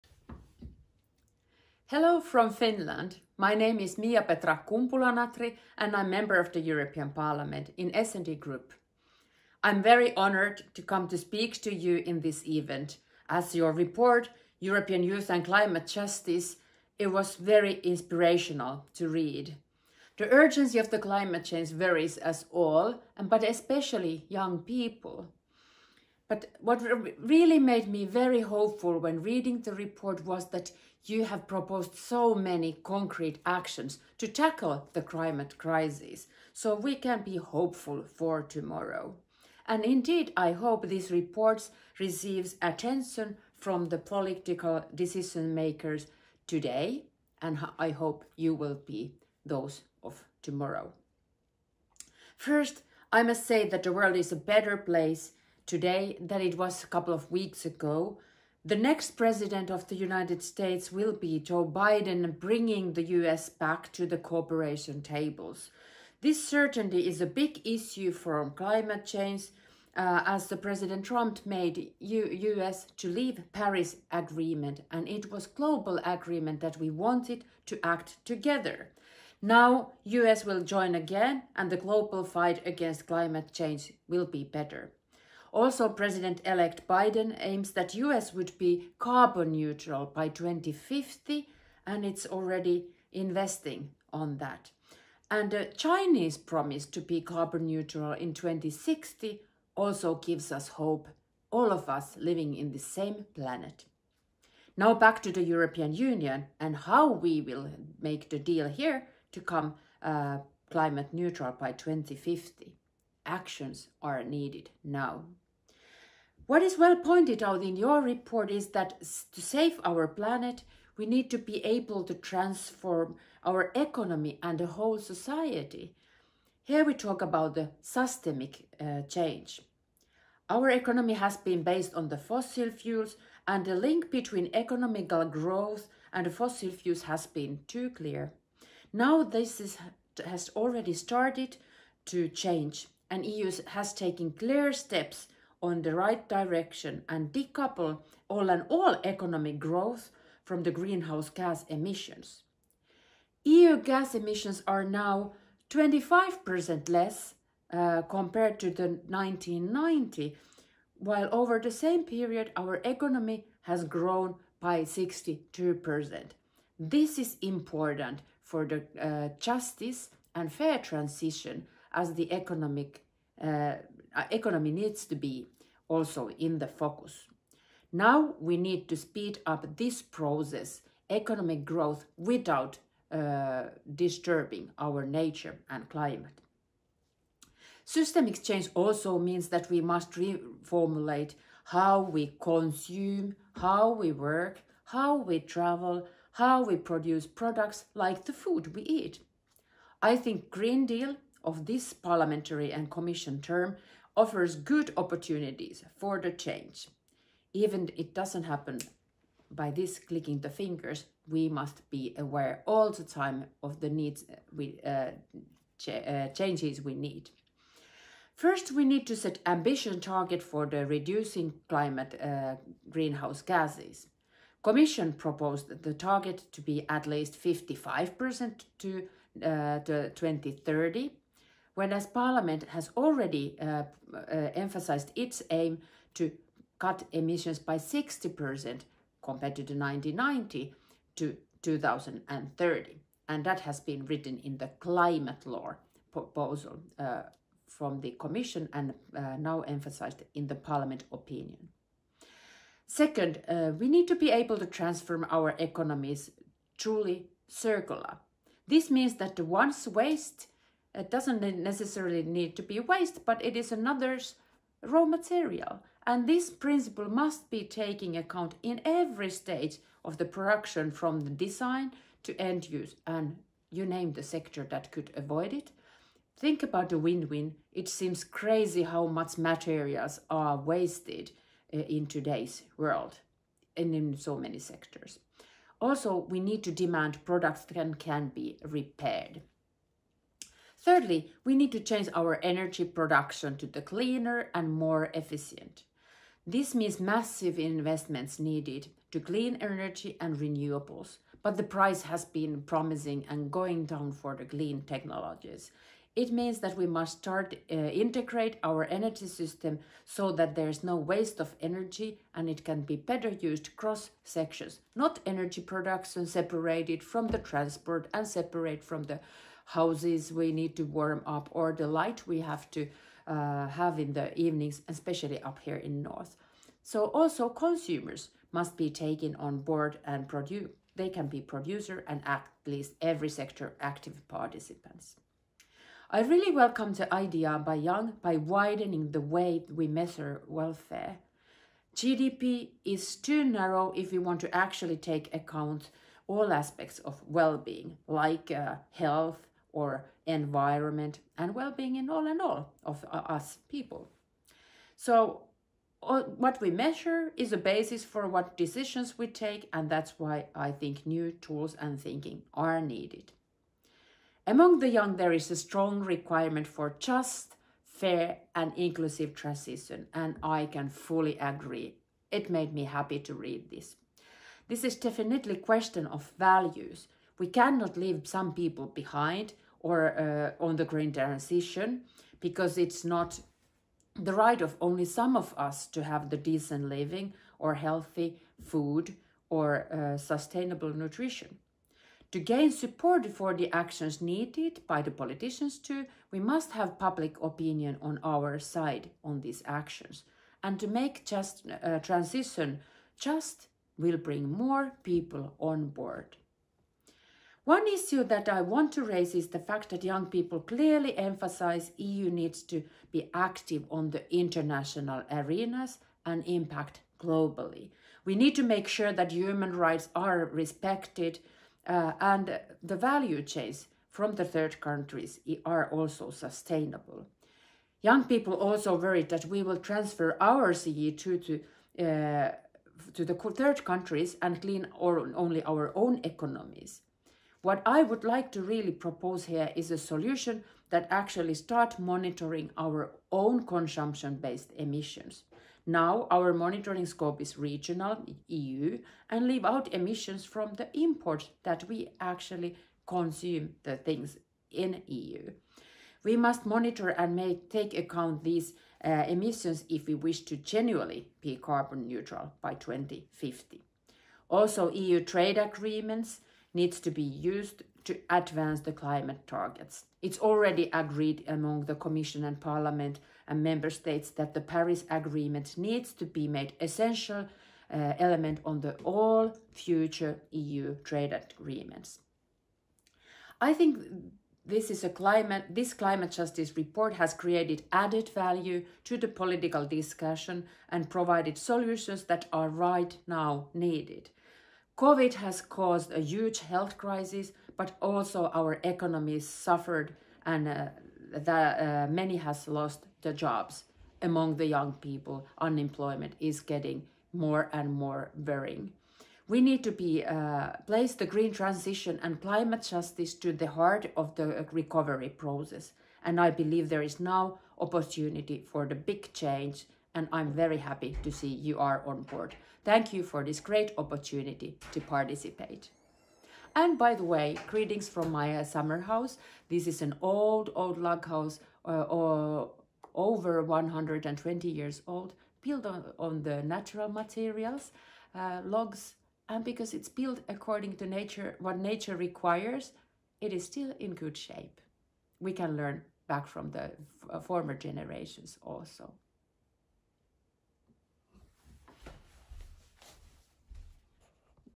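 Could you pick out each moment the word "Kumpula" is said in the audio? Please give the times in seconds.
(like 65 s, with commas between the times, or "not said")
4 s.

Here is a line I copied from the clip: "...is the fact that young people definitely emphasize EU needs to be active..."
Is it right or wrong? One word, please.
wrong.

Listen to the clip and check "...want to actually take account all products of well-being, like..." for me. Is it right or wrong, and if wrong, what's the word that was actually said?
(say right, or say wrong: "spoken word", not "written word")
wrong: "aspects", not "products".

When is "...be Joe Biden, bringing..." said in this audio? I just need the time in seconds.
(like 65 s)
61 s.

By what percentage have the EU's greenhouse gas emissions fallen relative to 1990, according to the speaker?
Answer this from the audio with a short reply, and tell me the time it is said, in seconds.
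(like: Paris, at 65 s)
25%, at 155 s.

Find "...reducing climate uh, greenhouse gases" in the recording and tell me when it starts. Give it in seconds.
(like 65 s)
220 s.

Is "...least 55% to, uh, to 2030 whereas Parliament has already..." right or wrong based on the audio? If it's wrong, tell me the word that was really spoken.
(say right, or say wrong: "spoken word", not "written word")
right.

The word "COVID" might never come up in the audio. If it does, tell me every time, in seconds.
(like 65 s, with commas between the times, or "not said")
494 s.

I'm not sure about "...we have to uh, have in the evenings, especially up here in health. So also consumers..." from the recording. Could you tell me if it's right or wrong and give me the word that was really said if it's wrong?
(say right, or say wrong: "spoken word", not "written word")
wrong: "north", not "health".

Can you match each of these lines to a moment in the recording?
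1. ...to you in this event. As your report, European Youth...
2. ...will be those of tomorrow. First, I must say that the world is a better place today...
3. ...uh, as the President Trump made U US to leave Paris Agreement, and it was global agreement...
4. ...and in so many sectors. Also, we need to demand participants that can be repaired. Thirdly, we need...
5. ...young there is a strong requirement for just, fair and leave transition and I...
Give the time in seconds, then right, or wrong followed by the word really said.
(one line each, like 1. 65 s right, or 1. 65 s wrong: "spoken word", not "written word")
1. 11 s right
2. 48 s right
3. 69 s right
4. 283 s wrong: "products", not "participants"
5. 364 s wrong: "inclusive", not "leave".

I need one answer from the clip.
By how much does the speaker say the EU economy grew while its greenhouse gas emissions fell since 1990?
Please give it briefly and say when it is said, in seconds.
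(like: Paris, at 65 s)
62%, at 164 s.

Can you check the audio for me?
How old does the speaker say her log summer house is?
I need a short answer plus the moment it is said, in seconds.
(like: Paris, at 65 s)
over 120 years, at 533 s.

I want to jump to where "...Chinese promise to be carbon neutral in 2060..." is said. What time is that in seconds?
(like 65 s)
95 s.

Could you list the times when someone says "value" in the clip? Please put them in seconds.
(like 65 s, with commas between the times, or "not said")
376 s, 422 s, 488 s.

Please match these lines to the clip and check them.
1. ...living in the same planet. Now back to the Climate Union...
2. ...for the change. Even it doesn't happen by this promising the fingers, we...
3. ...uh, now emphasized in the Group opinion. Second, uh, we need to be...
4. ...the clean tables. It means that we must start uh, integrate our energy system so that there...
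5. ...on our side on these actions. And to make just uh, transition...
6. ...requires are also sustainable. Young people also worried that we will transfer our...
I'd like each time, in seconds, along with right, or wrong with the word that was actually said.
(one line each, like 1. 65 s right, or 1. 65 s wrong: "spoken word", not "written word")
1. 102 s wrong: "European", not "Climate"
2. 205 s wrong: "clicking", not "promising"
3. 249 s wrong: "Parliament", not "Group"
4. 304 s wrong: "technologies", not "tables"
5. 398 s right
6. 424 s wrong: "countries", not "requires".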